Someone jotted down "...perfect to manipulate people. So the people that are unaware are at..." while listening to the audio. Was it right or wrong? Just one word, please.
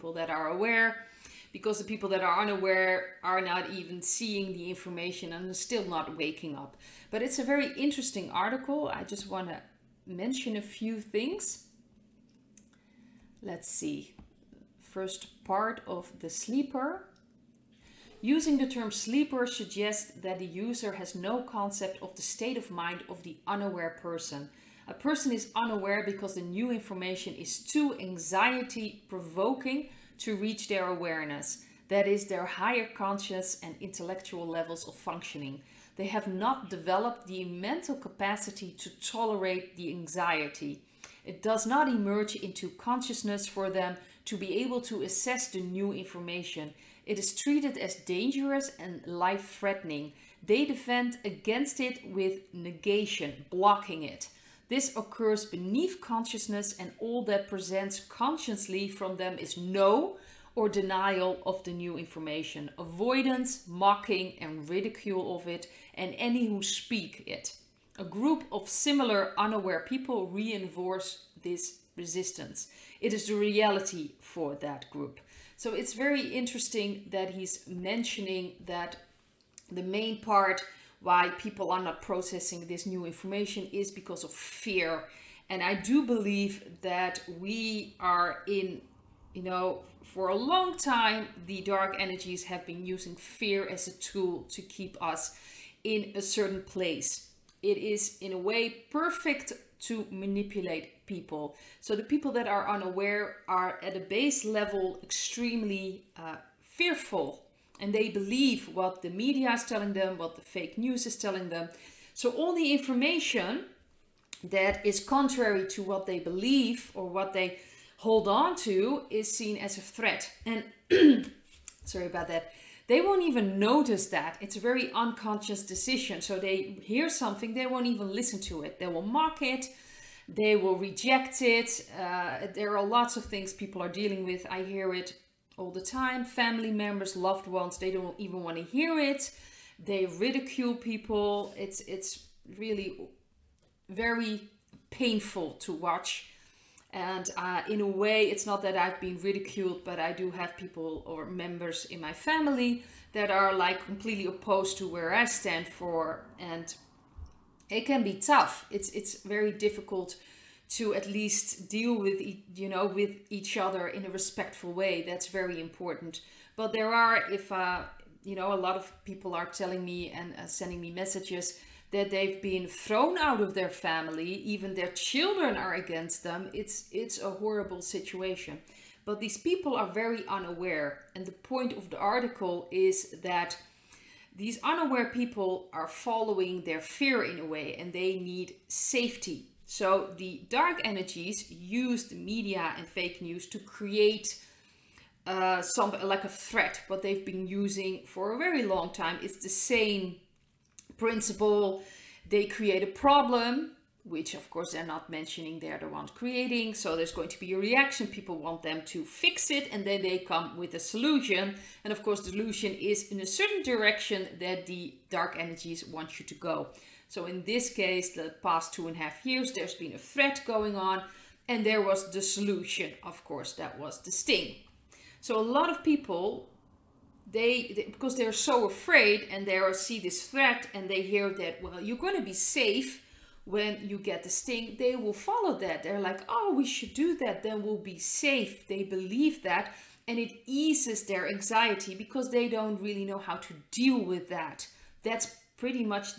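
right.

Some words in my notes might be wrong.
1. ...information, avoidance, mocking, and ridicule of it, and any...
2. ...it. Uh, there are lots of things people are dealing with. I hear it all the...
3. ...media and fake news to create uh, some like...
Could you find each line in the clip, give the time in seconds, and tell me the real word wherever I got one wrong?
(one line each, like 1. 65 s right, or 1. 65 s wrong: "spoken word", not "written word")
1. 61 s right
2. 131 s right
3. 192 s right.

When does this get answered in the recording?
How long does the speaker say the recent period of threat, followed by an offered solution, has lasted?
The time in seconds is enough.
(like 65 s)
218 s.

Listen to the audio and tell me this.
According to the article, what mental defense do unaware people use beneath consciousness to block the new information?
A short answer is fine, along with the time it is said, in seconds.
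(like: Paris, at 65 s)
negation, at 52 s.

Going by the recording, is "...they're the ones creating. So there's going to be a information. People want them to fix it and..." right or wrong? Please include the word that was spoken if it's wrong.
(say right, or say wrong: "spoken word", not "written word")
wrong: "reaction", not "information".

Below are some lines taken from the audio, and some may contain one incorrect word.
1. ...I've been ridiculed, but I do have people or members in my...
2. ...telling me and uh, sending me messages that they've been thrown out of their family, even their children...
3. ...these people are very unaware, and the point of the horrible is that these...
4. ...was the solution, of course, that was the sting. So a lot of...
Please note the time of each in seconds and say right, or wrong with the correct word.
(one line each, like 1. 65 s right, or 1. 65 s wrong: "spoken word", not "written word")
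1. 148 s right
2. 169 s right
3. 179 s wrong: "article", not "horrible"
4. 221 s right.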